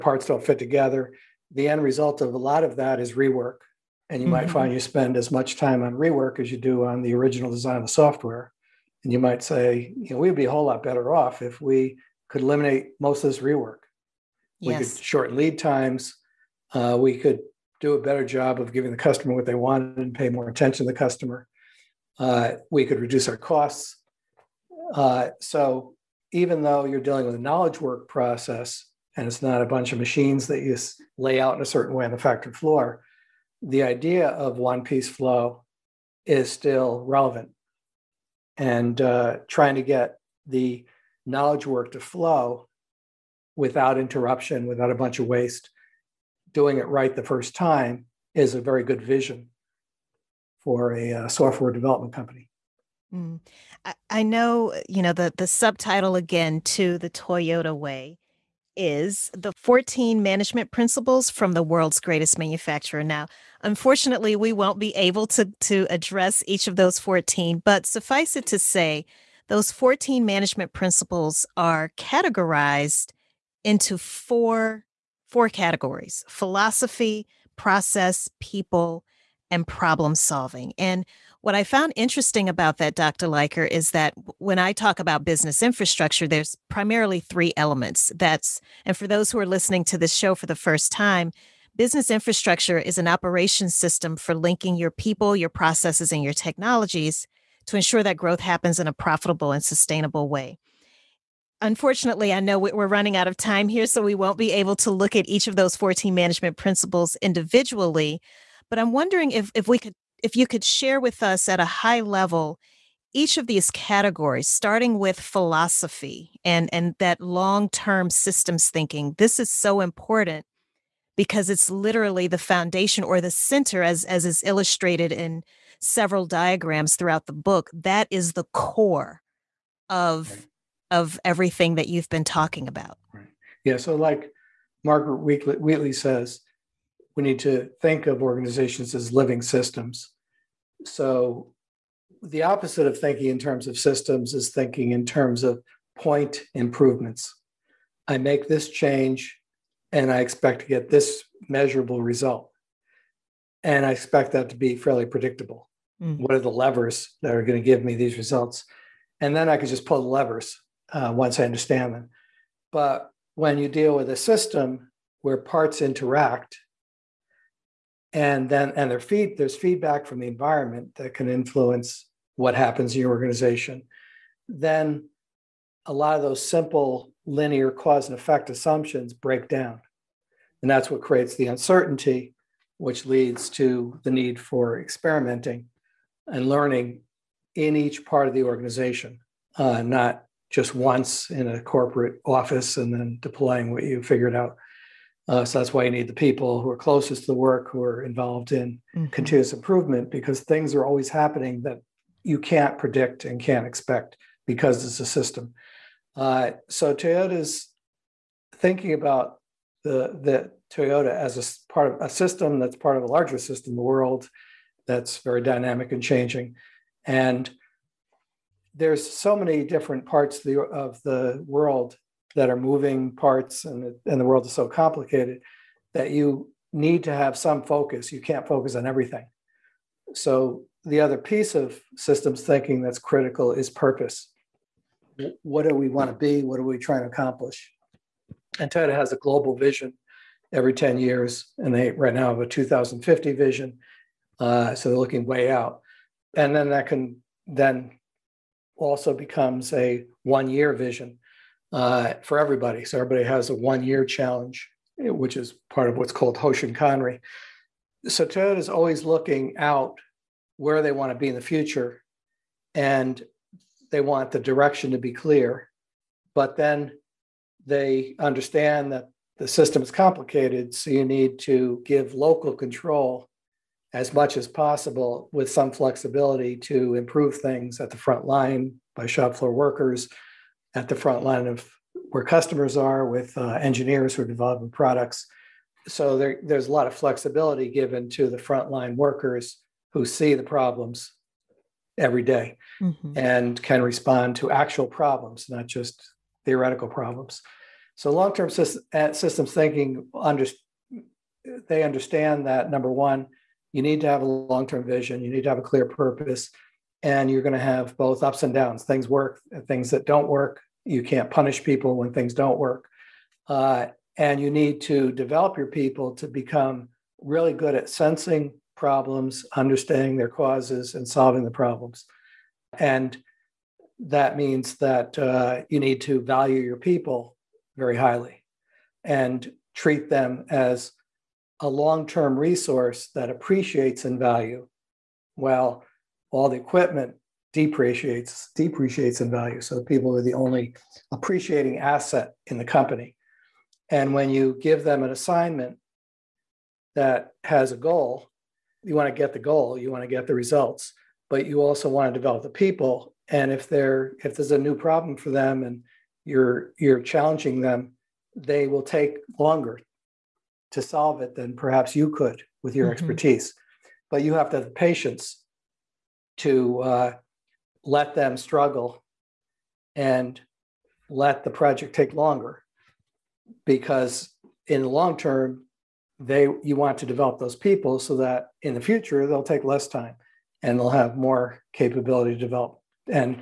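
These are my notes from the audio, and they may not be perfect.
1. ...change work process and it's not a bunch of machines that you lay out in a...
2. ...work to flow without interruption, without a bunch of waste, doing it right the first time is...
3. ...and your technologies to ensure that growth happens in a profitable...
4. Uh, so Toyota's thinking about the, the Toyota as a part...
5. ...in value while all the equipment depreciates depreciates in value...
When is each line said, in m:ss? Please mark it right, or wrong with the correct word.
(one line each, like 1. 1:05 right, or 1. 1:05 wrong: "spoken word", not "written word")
1. 0:27 wrong: "knowledge", not "change"
2. 0:41 right
3. 1:36 right
4. 3:26 right
5. 5:34 right.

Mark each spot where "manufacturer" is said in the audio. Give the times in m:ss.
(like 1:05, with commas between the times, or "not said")
1:02.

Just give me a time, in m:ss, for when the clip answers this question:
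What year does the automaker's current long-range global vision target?
4:02.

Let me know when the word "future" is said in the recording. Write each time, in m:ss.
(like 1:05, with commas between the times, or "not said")
4:21, 6:18.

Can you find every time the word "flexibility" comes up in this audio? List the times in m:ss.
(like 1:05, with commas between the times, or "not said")
4:35, 4:46.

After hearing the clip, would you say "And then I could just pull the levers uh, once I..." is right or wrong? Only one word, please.
right.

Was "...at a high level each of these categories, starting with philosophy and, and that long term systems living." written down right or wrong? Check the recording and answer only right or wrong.
wrong.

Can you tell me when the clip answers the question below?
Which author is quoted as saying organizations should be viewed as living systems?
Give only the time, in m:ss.
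2:14.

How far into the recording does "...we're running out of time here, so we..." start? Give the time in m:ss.
1:42.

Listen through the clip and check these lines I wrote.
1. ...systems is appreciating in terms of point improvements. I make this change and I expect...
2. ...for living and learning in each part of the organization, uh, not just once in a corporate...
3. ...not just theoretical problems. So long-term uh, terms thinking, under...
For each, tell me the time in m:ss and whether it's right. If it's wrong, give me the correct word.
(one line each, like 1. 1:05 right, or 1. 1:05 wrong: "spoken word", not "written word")
1. 2:23 wrong: "thinking", not "appreciating"
2. 3:04 wrong: "experimenting", not "living"
3. 4:55 wrong: "systems", not "terms".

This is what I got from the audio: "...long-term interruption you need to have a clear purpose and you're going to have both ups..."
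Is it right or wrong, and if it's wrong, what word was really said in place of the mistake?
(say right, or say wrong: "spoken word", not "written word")
wrong: "vision", not "interruption".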